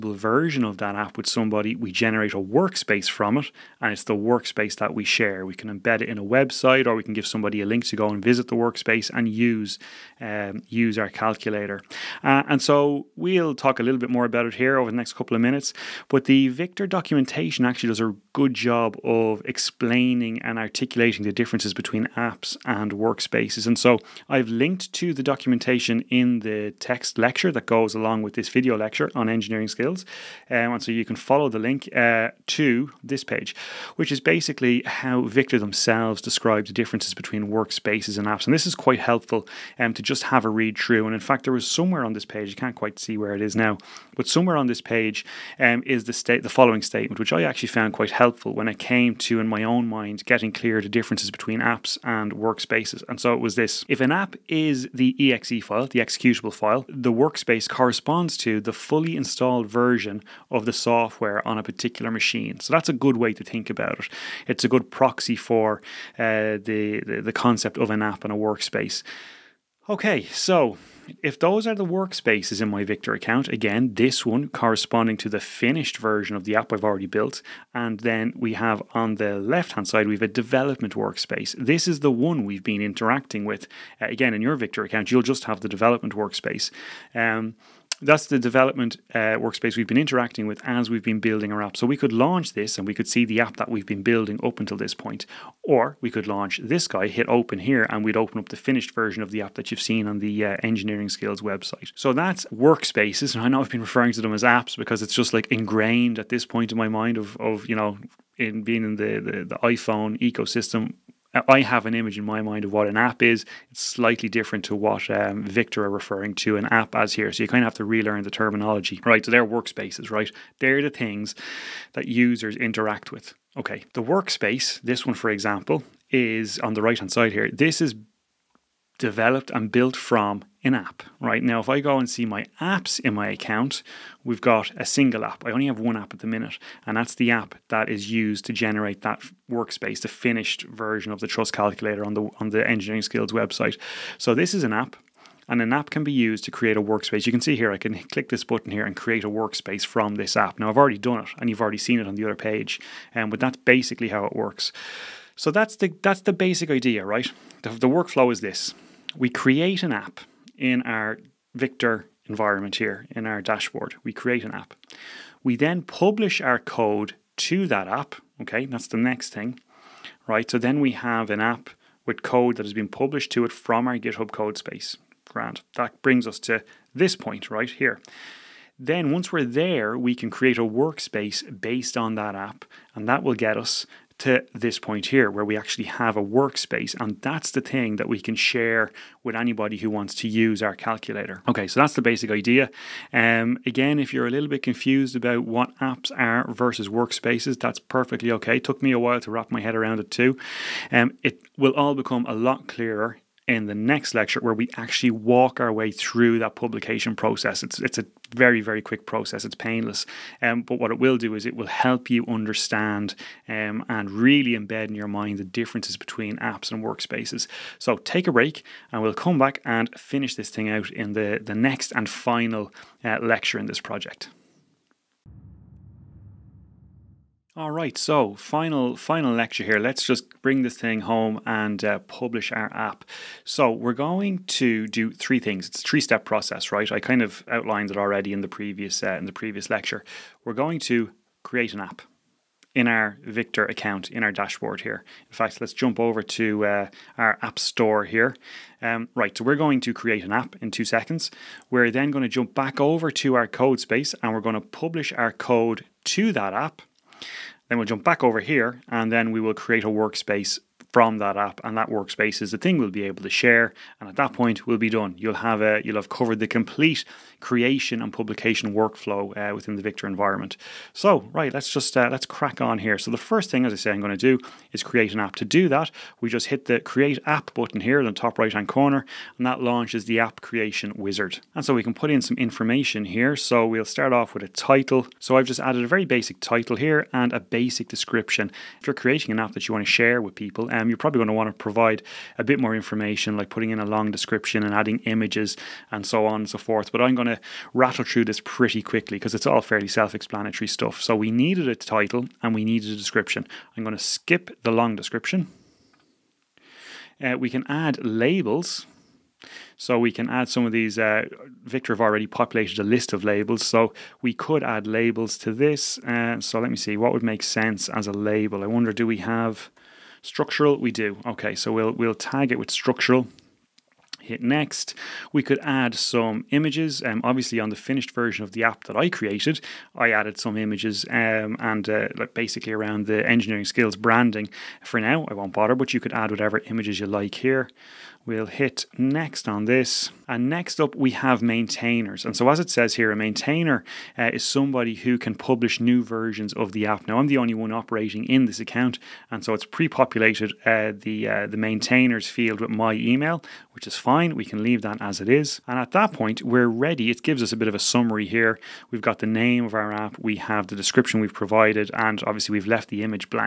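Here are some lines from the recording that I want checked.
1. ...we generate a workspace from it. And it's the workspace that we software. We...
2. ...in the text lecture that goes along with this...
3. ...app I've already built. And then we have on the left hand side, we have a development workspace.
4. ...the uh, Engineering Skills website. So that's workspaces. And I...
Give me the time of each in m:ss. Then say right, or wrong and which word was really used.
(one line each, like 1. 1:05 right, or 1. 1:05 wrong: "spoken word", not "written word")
1. 0:01 wrong: "share", not "software"
2. 0:26 right
3. 1:16 right
4. 1:40 right.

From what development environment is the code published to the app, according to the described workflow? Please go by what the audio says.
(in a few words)
GitHub code space.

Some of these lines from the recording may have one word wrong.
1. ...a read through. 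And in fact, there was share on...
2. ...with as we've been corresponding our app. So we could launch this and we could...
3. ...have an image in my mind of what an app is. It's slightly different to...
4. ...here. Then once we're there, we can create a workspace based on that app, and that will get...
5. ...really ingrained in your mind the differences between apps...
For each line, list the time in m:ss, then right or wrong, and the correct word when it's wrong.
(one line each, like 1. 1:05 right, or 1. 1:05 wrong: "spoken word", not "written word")
1. 0:40 wrong: "somewhere", not "share"
2. 1:30 wrong: "building", not "corresponding"
3. 1:51 right
4. 2:57 right
5. 3:34 wrong: "embed", not "ingrained".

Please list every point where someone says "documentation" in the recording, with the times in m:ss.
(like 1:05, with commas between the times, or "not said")
0:16, 0:25.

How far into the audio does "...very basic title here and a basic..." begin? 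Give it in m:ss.
4:45.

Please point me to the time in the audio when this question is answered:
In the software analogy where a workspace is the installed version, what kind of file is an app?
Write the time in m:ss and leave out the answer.
0:55.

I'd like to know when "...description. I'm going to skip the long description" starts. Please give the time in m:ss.
5:02.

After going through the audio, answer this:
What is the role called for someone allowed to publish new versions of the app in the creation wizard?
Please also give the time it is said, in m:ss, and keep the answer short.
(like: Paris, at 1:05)
maintainer, at 5:43.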